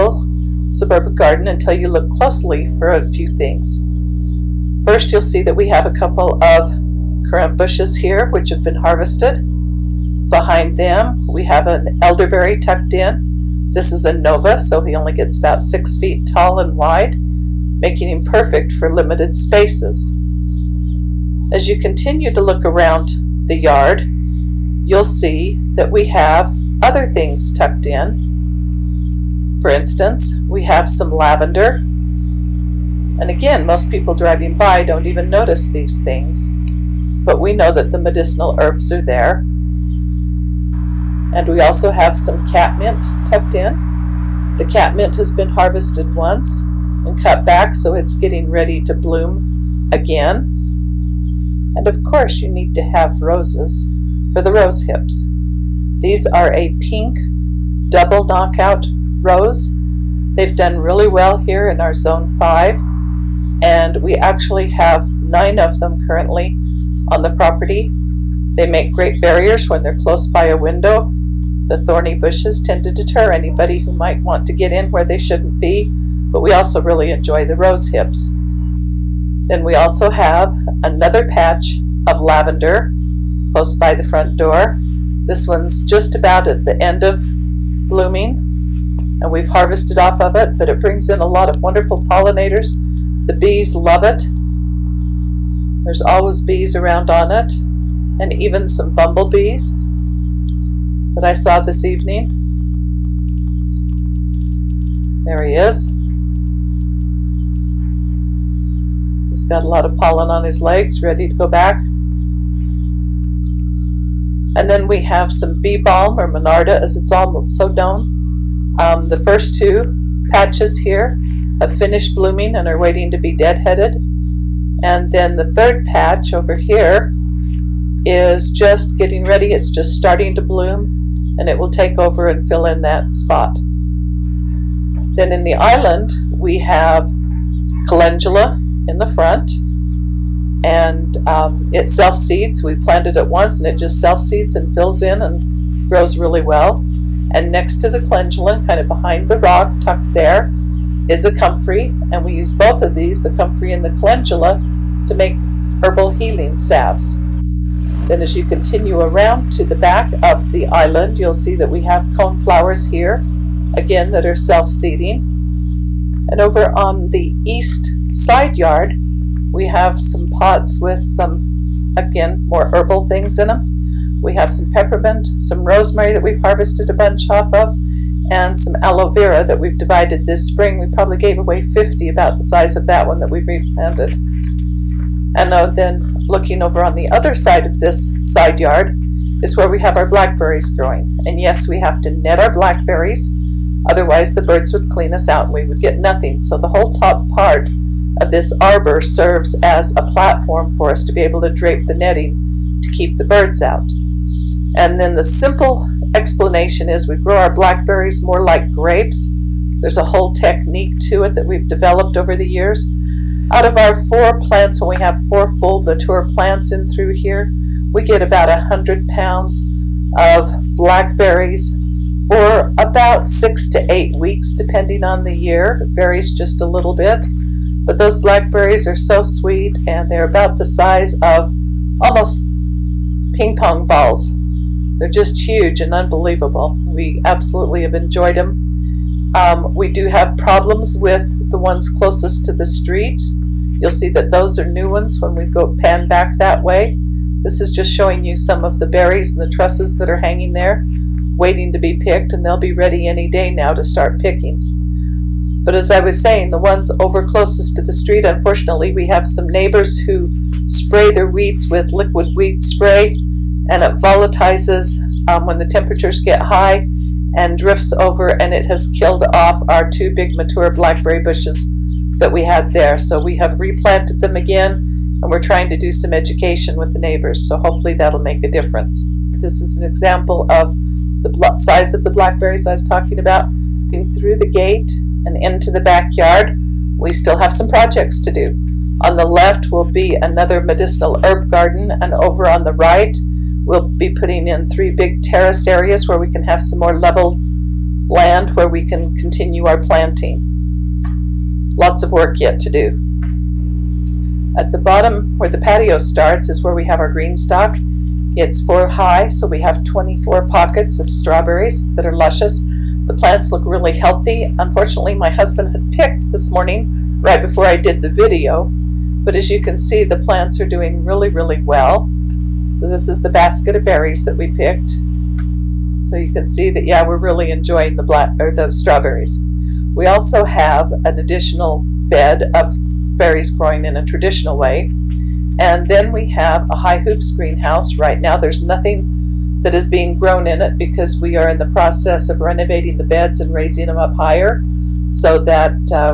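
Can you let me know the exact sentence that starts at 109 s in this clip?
He's got a lot of pollen on his legs, ready to go back.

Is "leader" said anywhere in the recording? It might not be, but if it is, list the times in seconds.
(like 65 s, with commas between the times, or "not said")
not said.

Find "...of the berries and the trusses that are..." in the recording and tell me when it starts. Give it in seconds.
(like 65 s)
248 s.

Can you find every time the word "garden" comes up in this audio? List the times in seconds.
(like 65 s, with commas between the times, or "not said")
1 s, 291 s.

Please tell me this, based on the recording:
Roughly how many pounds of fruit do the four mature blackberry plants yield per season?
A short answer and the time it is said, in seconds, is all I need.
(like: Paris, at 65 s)
100 pounds, at 218 s.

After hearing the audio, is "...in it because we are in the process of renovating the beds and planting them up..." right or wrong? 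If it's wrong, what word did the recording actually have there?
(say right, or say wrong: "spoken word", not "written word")
wrong: "raising", not "planting".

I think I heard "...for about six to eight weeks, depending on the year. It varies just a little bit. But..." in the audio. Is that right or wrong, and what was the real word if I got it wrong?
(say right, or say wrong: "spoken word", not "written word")
right.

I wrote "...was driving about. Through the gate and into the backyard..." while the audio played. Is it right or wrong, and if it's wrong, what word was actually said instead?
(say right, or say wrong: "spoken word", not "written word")
wrong: "talking", not "driving".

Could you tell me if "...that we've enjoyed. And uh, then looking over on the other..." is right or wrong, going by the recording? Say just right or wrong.
wrong.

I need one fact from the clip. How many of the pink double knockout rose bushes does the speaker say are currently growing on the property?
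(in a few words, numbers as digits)
9.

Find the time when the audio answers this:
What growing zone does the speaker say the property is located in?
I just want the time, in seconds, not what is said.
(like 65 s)
61 s.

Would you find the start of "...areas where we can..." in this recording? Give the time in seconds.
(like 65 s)
295 s.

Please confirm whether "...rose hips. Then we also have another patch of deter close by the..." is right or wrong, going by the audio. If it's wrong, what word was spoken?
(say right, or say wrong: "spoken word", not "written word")
wrong: "lavender", not "deter".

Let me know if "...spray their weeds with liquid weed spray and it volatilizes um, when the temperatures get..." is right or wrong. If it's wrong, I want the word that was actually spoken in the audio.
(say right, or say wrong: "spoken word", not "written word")
right.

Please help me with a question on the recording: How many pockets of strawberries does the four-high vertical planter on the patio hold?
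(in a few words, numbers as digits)
24.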